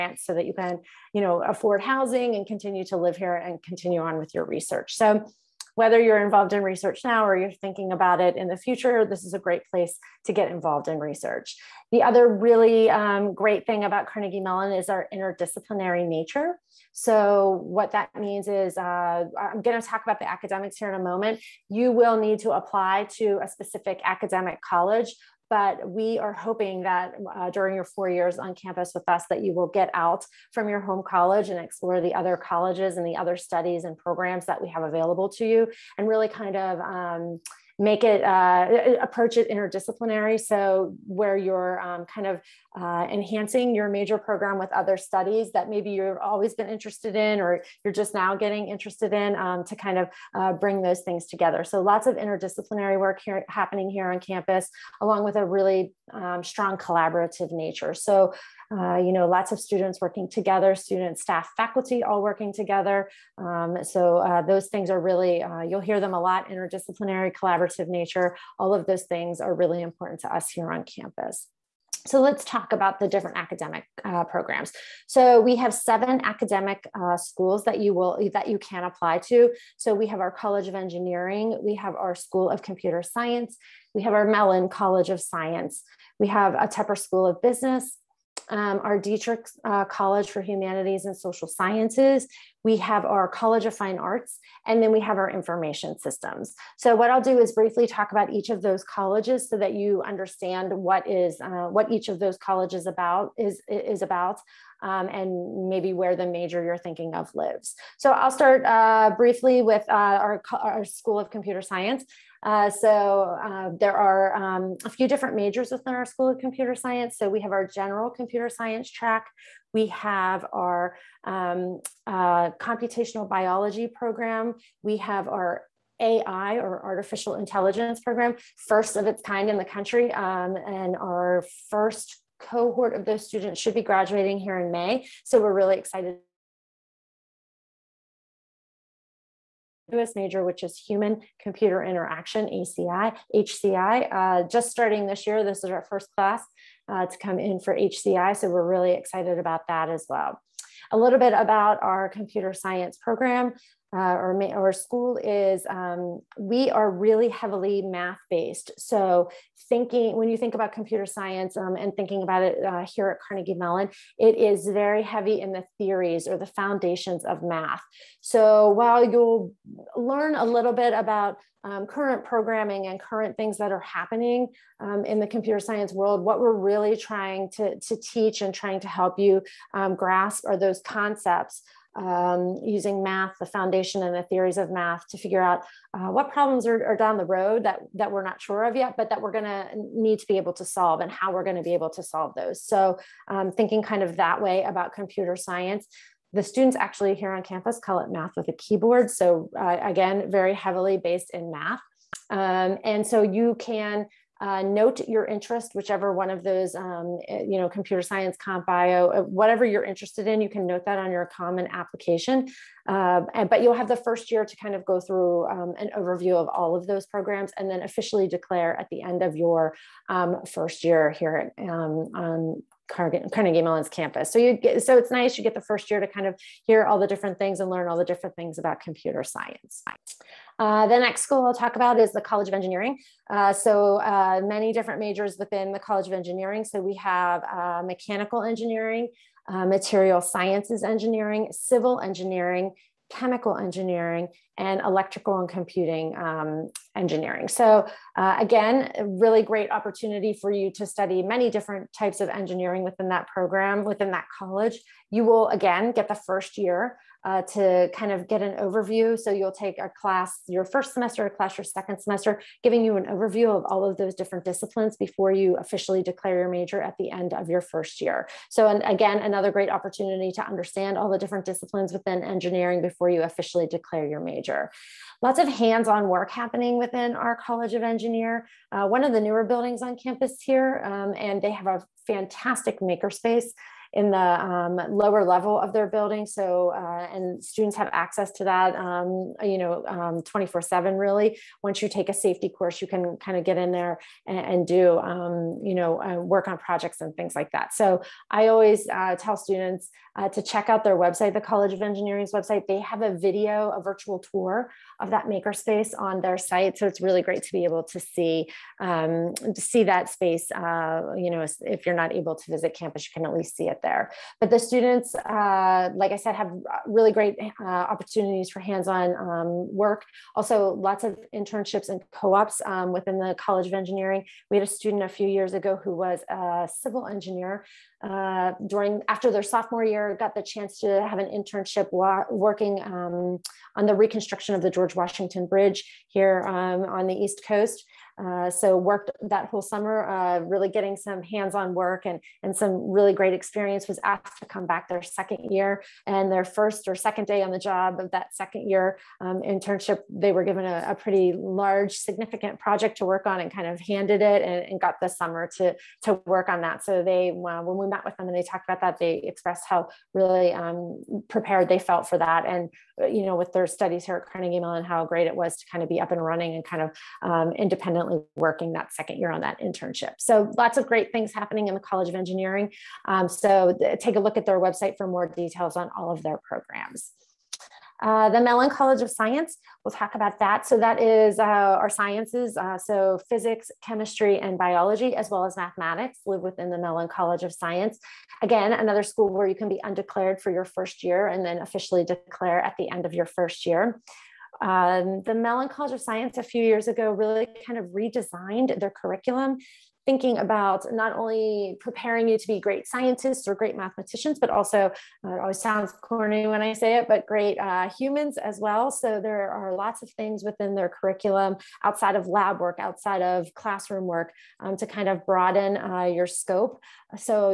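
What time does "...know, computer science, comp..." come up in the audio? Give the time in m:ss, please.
3:27.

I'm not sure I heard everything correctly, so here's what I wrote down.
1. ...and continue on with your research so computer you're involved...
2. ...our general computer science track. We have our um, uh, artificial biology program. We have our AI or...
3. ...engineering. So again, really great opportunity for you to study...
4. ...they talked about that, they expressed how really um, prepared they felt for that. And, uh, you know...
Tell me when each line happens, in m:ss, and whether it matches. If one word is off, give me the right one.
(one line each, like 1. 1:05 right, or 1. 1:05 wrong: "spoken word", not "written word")
1. 0:03 wrong: "whether", not "computer"
2. 1:57 wrong: "computational", not "artificial"
3. 4:06 right
4. 5:58 right.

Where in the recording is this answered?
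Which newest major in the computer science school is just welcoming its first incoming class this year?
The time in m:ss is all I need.
2:20.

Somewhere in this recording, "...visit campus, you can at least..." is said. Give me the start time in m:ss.
5:12.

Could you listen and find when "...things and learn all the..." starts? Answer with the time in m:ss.
3:47.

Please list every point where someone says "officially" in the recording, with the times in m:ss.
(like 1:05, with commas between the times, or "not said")
3:37, 4:25, 4:33, 6:31.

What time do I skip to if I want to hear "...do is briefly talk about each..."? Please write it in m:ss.
1:37.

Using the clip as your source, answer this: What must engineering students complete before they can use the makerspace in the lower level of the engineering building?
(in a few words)
A safety course.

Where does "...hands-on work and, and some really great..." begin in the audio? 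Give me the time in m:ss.
5:41.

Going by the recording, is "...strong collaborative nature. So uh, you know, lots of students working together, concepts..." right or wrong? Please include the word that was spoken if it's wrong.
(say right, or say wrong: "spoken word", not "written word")
wrong: "students", not "concepts".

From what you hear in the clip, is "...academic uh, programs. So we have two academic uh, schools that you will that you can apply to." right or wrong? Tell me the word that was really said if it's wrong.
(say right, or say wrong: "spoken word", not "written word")
wrong: "seven", not "two".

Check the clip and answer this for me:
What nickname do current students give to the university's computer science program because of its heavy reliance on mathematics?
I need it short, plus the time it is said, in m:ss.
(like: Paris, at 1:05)
Math with a keyboard, at 3:18.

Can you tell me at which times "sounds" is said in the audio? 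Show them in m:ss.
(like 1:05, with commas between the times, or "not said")
6:45.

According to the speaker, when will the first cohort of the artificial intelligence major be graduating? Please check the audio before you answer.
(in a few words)
May.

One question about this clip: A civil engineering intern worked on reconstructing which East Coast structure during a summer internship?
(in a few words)
George Washington Bridge.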